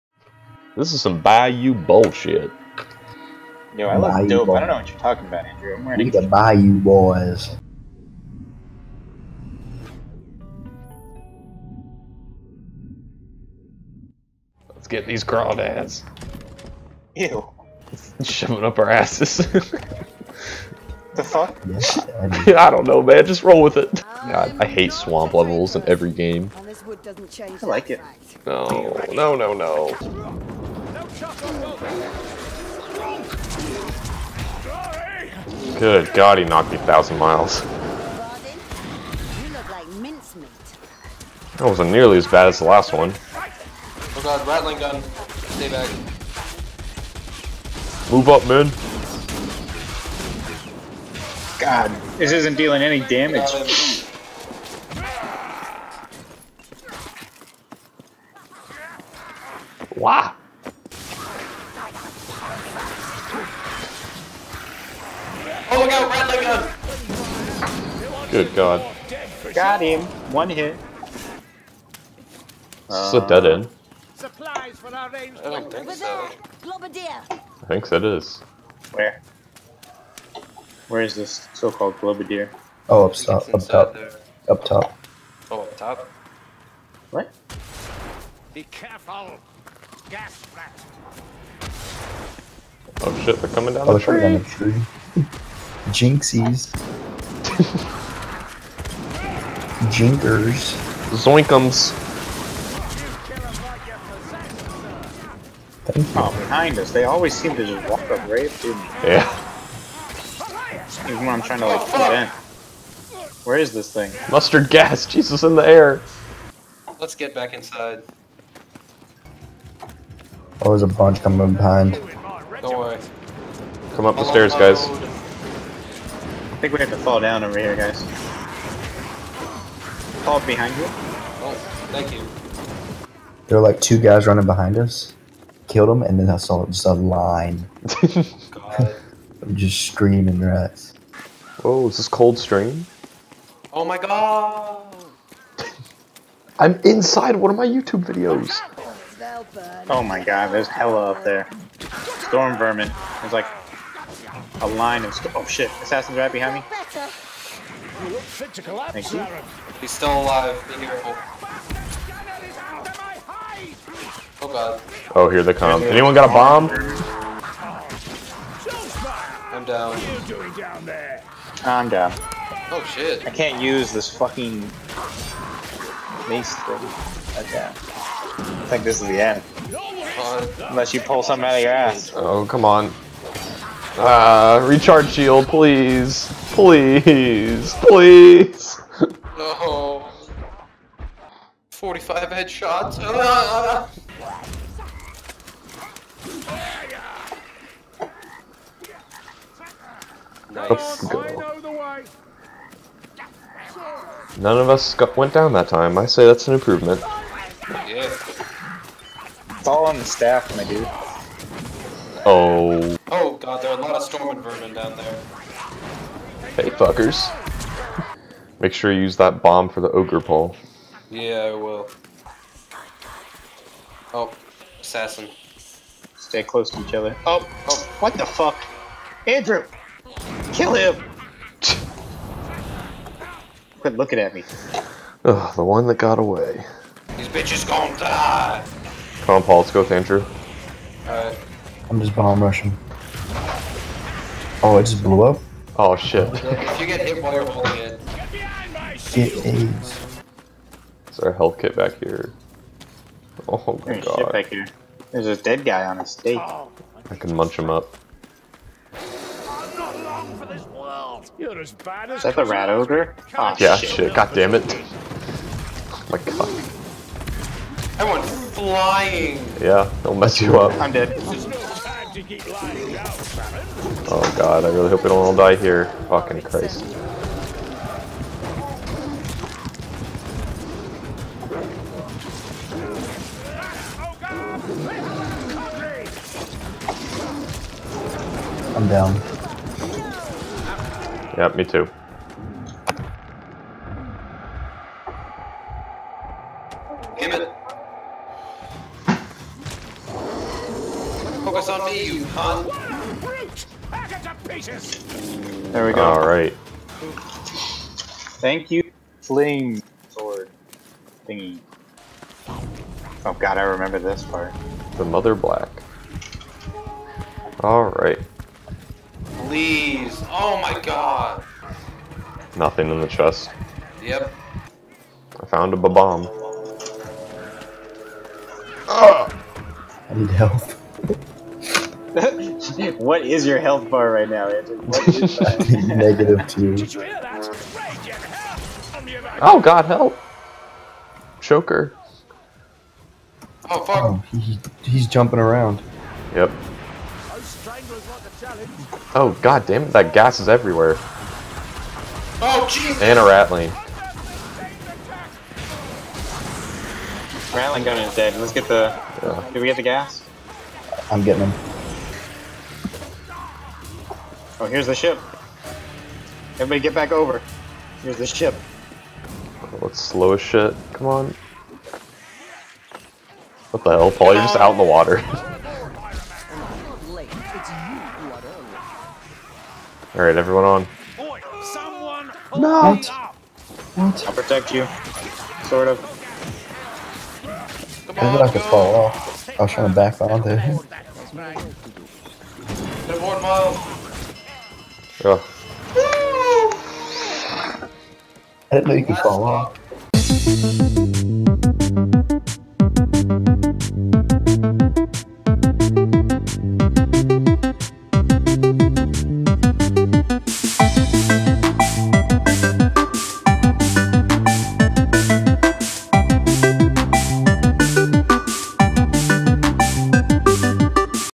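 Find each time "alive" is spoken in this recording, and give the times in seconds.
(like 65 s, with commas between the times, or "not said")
160 s.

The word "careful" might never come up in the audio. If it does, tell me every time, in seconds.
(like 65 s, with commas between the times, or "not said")
88 s, 160 s.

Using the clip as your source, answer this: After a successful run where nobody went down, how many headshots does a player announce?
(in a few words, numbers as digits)
45.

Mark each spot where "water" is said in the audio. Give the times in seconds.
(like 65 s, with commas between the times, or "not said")
374 s.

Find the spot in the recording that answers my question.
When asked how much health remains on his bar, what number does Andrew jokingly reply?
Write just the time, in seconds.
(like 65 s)
335 s.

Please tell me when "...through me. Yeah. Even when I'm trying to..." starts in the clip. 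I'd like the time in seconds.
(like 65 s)
108 s.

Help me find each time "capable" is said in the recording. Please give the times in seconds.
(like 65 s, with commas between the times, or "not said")
not said.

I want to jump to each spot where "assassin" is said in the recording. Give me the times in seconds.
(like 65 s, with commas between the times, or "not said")
155 s, 224 s.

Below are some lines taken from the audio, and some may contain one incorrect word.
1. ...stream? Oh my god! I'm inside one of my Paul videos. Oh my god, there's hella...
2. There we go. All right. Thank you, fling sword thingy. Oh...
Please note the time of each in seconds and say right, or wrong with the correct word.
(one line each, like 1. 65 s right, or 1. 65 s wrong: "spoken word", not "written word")
1. 142 s wrong: "YouTube", not "Paul"
2. 305 s right.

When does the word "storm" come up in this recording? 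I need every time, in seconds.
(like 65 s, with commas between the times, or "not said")
152 s, 214 s.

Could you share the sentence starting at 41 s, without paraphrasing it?
That wasn't nearly as bad as the last one.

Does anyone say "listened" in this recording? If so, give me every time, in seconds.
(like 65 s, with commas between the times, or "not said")
not said.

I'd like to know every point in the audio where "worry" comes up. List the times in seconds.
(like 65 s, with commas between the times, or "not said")
122 s.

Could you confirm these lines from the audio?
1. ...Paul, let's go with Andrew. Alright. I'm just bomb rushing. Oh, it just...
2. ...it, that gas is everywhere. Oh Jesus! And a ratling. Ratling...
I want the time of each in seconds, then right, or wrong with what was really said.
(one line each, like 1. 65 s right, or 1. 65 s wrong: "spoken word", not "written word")
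1. 239 s right
2. 349 s right.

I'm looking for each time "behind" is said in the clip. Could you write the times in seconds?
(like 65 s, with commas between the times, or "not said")
106 s, 121 s, 130 s, 134 s, 156 s.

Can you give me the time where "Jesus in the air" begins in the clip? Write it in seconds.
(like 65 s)
115 s.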